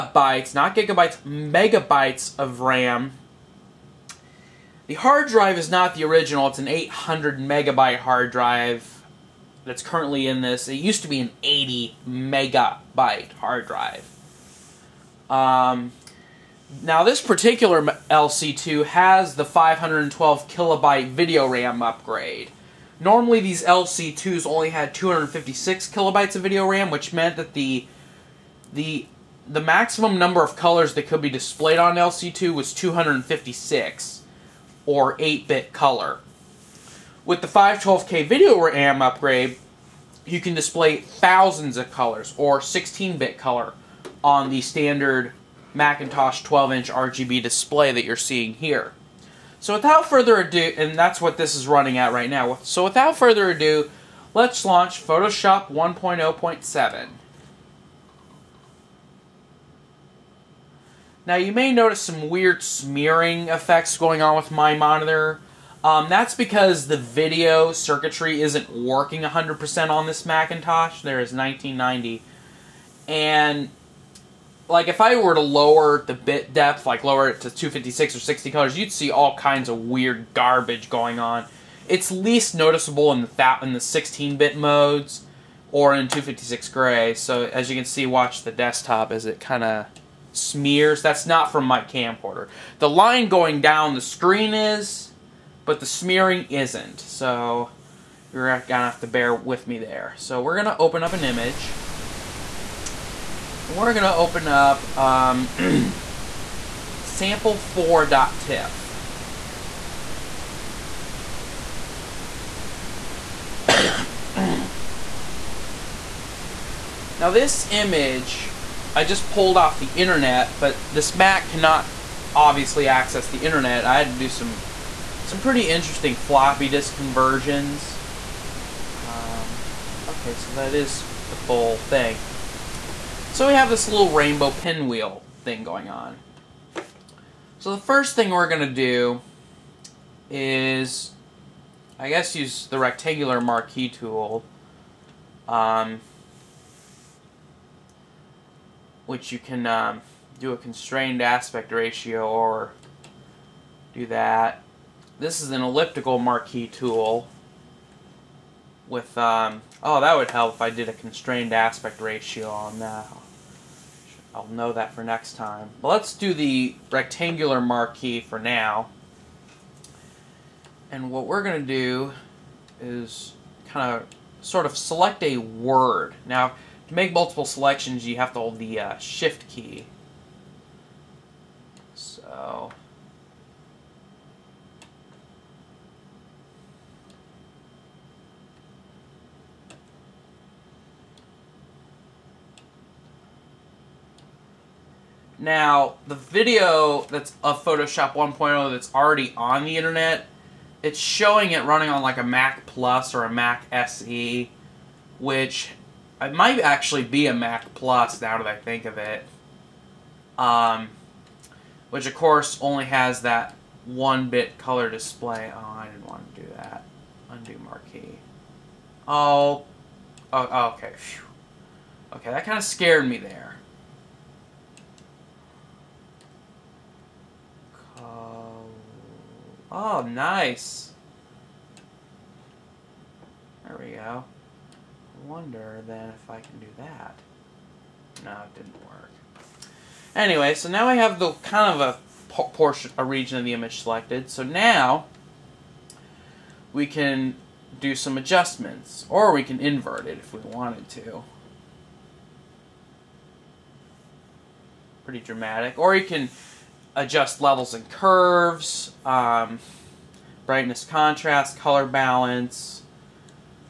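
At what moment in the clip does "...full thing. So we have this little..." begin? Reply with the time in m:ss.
2:11.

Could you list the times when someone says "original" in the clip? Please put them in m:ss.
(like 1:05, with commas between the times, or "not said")
0:06.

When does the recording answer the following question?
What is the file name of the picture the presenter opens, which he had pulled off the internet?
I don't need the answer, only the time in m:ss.
1:47.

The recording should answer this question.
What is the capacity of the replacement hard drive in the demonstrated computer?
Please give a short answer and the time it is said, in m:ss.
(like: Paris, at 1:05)
800 megabytes, at 0:06.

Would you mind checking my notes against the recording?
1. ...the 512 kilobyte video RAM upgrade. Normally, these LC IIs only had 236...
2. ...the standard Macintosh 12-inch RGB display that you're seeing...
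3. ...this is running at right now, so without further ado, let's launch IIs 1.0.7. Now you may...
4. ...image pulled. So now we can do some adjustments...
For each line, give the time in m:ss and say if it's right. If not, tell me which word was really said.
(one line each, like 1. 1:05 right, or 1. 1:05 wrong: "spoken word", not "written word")
1. 0:19 wrong: "256", not "236"
2. 0:44 right
3. 0:51 wrong: "Photoshop", not "IIs"
4. 4:03 wrong: "selected", not "pulled".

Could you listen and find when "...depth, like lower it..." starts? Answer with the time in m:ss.
1:16.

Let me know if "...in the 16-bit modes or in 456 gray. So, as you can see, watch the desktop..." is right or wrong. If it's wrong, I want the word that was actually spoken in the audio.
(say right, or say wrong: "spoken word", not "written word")
wrong: "256", not "456".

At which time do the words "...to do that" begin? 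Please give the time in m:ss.
3:36.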